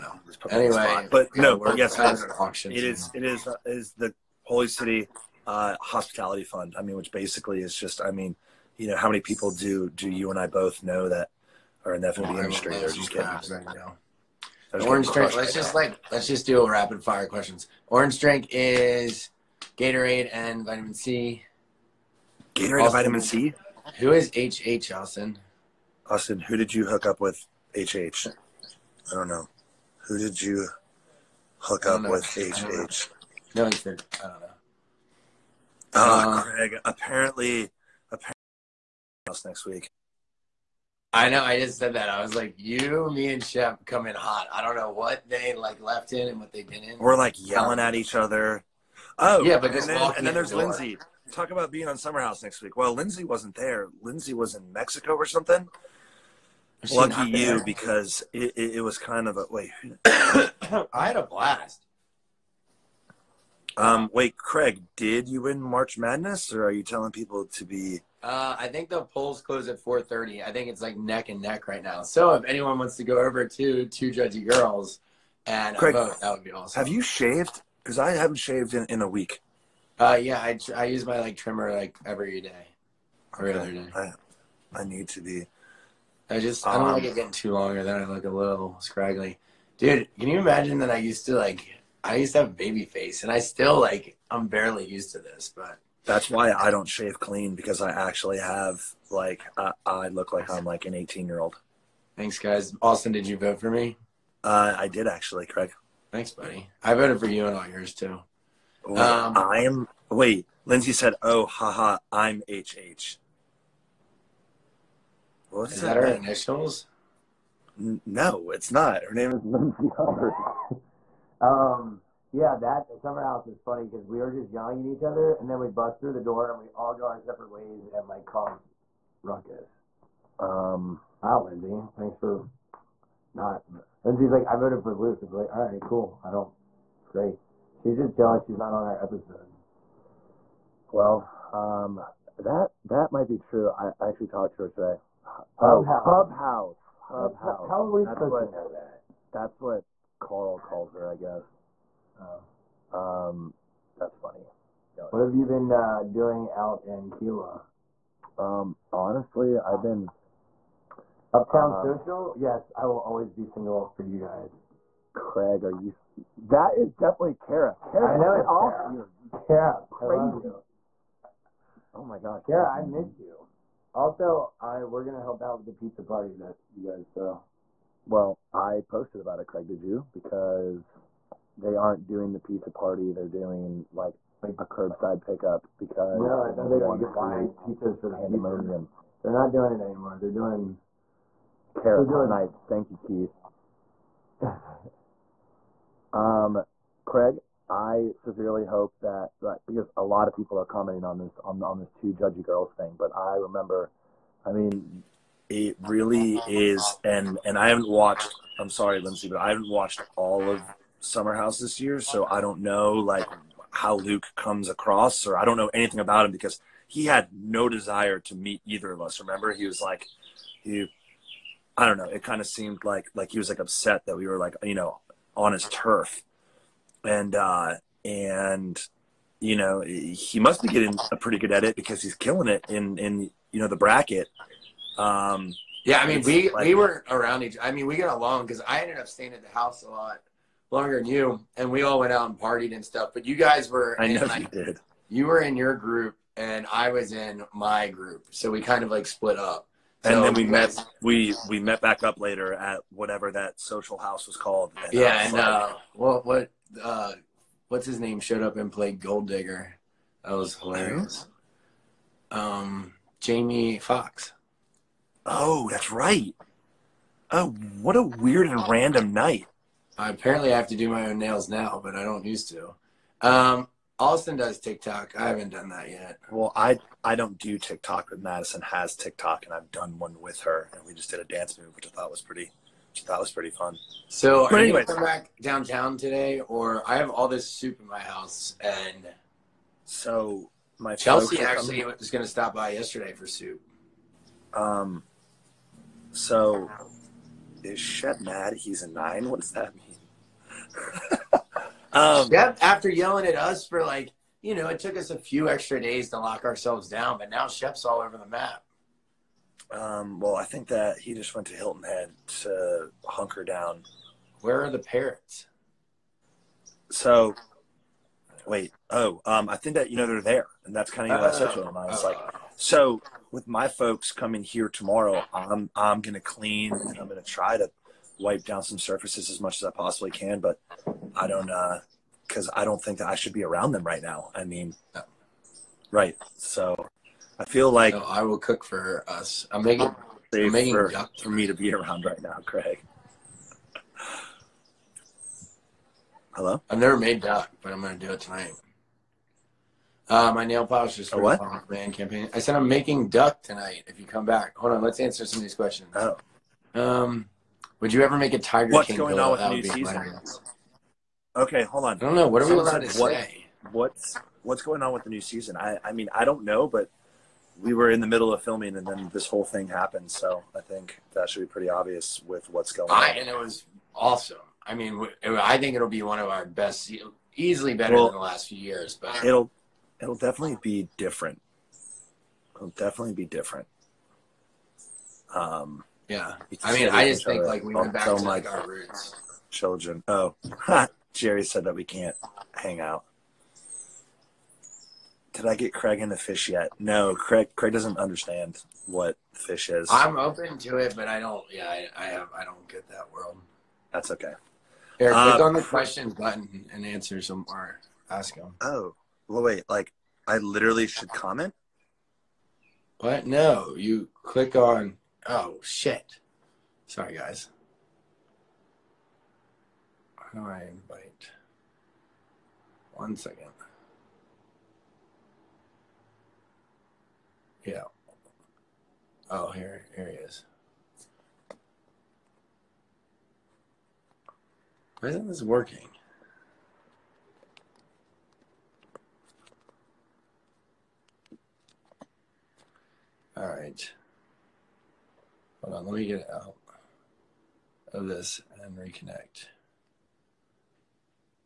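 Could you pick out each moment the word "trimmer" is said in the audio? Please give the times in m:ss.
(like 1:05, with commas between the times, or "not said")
1:21.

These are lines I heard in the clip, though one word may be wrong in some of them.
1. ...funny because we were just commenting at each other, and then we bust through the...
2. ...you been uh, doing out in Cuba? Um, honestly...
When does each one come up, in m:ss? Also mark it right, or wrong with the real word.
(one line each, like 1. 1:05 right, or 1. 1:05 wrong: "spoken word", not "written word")
1. 2:03 wrong: "yelling", not "commenting"
2. 2:35 right.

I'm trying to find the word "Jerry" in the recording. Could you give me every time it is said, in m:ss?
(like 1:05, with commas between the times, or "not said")
6:31.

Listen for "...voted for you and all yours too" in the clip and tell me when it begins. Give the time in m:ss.
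1:46.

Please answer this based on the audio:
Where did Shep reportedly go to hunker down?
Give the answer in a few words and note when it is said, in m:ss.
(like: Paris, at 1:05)
Hilton Head, at 5:11.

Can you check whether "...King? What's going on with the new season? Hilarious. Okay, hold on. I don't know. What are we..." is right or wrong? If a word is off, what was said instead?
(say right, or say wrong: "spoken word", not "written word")
right.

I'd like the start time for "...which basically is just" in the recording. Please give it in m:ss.
0:06.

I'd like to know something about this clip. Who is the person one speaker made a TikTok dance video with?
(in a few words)
Madison.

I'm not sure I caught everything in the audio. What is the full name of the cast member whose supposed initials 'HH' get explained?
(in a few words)
Lindsay Hubbard.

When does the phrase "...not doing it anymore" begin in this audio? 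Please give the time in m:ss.
3:09.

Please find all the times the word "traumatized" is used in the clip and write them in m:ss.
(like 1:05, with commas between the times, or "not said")
not said.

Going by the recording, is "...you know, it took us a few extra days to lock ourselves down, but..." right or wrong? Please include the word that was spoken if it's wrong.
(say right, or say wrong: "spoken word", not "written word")
right.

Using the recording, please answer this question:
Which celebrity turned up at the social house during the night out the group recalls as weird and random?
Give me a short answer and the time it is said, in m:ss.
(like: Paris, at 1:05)
Jamie Foxx, at 4:23.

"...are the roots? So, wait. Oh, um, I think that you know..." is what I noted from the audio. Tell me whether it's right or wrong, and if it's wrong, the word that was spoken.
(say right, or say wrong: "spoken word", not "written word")
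wrong: "parrots", not "roots".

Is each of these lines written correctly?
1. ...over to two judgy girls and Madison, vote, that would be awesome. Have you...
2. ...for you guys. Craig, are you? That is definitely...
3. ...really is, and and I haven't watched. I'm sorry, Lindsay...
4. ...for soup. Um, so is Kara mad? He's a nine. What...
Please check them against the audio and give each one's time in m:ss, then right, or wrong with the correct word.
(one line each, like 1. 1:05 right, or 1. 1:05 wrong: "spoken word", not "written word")
1. 1:13 wrong: "Craig", not "Madison"
2. 2:43 right
3. 3:25 right
4. 4:53 wrong: "Shep", not "Kara".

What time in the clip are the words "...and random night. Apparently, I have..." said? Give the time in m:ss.
4:28.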